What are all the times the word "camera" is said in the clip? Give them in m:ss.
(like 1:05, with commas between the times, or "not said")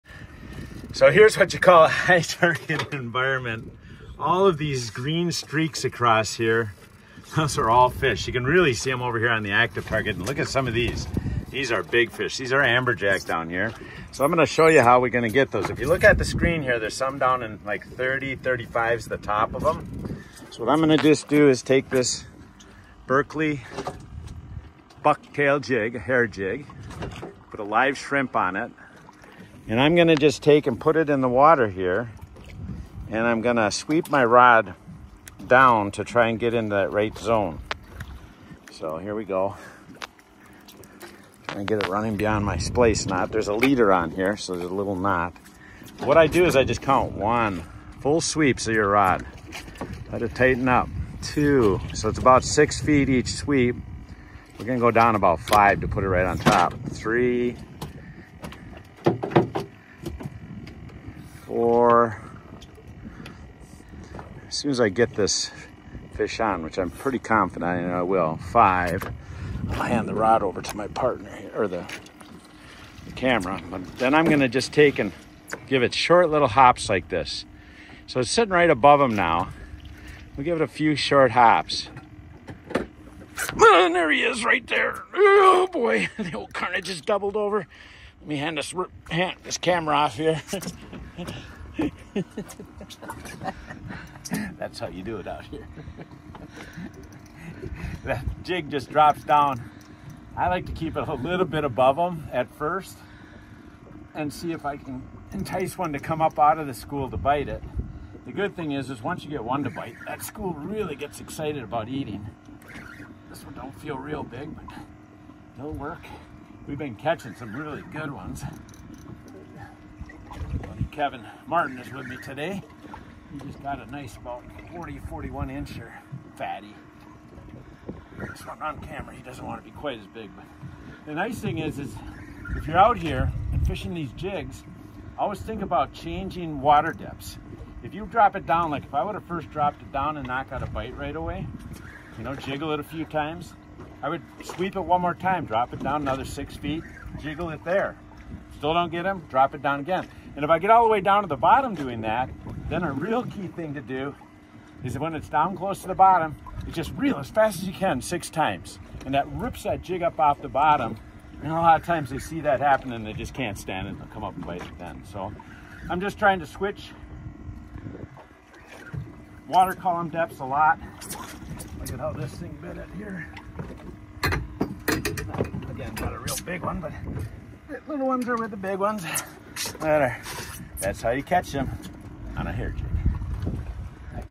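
1:13, 1:29, 2:08.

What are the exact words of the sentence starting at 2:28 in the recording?
Still don't get him, drop it down again.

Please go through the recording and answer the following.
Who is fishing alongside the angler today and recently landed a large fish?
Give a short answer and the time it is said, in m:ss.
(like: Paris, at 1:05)
Kevin Martin, at 2:01.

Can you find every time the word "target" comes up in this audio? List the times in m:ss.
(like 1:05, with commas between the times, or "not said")
0:02, 0:09.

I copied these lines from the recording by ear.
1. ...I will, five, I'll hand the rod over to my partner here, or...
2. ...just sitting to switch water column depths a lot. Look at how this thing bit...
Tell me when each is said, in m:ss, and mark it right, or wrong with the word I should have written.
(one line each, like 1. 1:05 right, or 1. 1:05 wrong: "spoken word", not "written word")
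1. 1:07 right
2. 2:45 wrong: "trying", not "sitting".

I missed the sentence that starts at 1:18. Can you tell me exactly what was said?
So it's sitting right above him now.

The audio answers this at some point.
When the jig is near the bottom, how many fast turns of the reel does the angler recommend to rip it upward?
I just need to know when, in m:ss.
2:38.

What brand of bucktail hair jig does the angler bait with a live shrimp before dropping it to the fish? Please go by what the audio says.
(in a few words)
Berkley.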